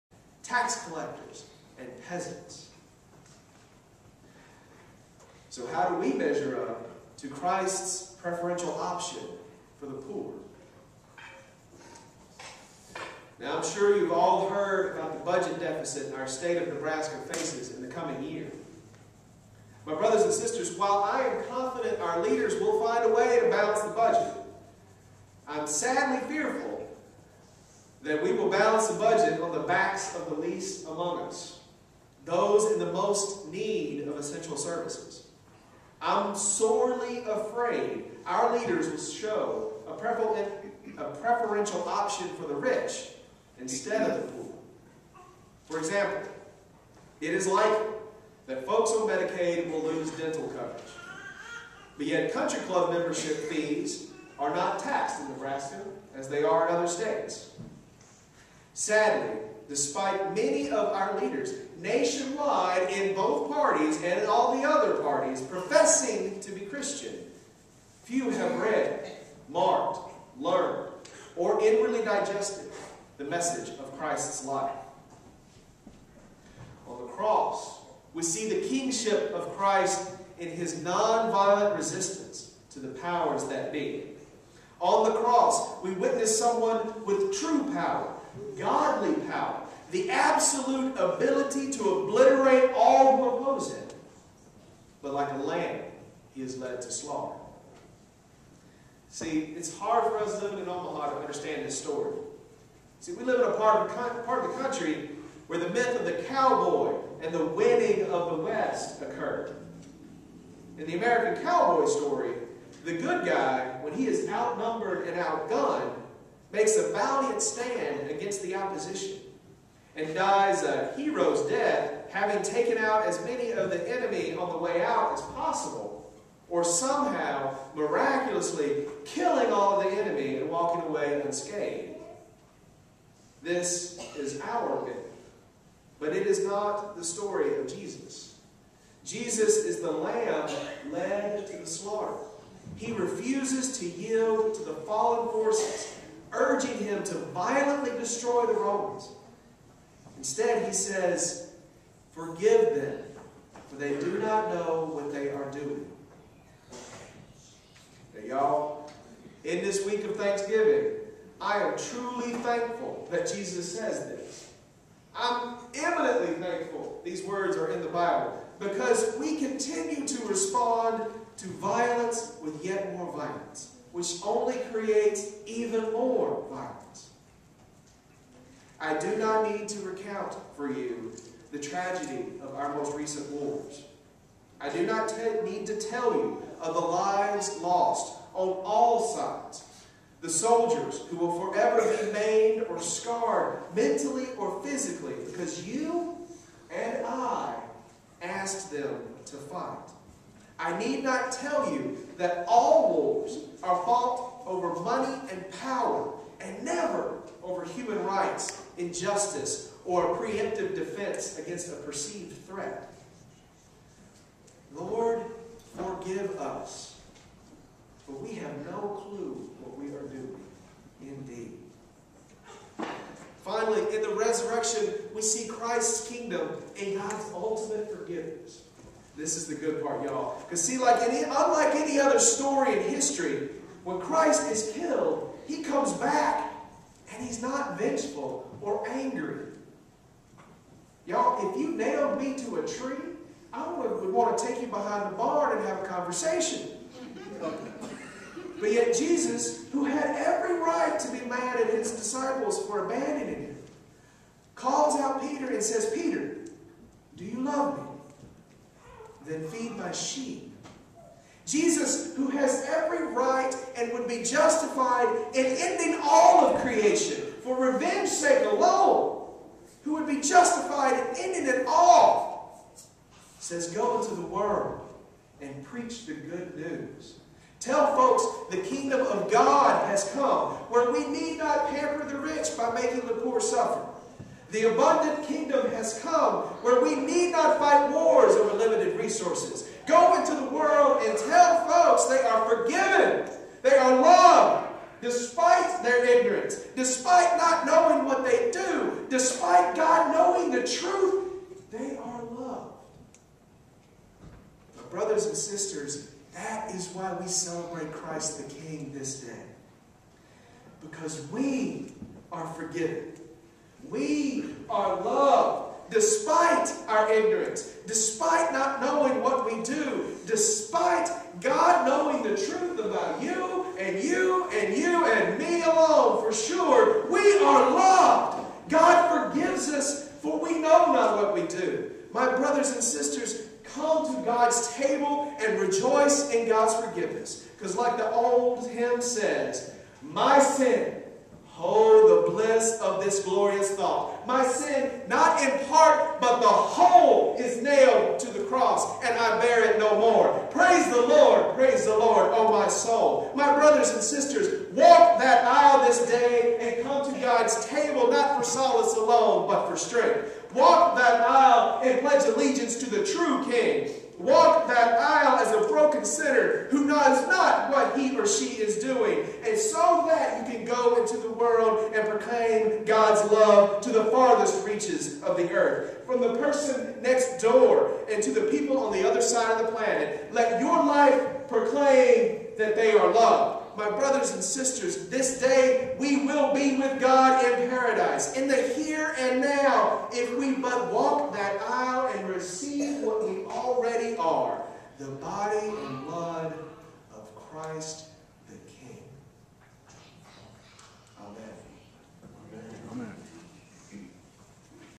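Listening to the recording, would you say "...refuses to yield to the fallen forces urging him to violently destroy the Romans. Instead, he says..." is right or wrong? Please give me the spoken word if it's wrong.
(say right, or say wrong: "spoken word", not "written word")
right.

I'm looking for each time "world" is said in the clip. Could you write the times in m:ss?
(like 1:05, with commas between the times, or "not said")
4:34, 4:50, 6:11.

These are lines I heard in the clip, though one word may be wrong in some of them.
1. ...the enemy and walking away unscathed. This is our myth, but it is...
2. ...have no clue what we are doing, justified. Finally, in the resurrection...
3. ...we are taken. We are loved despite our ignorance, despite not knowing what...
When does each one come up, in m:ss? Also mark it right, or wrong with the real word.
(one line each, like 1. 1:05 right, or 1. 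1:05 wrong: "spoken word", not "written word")
1. 2:09 right
2. 3:38 wrong: "indeed", not "justified"
3. 5:11 wrong: "forgiven", not "taken".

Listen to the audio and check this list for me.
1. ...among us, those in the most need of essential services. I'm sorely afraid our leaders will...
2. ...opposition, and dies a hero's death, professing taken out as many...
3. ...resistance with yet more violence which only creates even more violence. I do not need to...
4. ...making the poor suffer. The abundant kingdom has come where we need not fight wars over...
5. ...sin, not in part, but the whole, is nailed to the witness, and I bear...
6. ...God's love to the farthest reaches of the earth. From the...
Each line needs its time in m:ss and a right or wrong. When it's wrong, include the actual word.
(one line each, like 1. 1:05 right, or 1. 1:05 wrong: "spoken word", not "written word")
1. 0:30 right
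2. 1:58 wrong: "having", not "professing"
3. 2:51 wrong: "violence", not "resistance"
4. 4:42 right
5. 5:44 wrong: "cross", not "witness"
6. 6:12 right.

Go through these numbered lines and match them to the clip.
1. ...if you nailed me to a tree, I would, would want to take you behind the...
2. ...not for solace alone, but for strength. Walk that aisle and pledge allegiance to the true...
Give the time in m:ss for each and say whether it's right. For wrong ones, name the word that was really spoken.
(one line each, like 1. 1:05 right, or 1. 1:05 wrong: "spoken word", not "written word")
1. 4:01 right
2. 5:58 right.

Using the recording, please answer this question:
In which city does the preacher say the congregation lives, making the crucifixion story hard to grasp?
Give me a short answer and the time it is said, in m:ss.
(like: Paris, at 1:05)
Omaha, at 1:40.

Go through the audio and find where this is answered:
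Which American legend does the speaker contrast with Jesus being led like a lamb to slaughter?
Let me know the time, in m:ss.
1:46.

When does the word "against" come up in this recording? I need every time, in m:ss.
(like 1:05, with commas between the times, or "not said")
1:58, 3:31.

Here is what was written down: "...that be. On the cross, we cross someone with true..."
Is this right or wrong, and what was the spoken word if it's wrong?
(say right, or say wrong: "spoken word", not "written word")
wrong: "witness", not "cross".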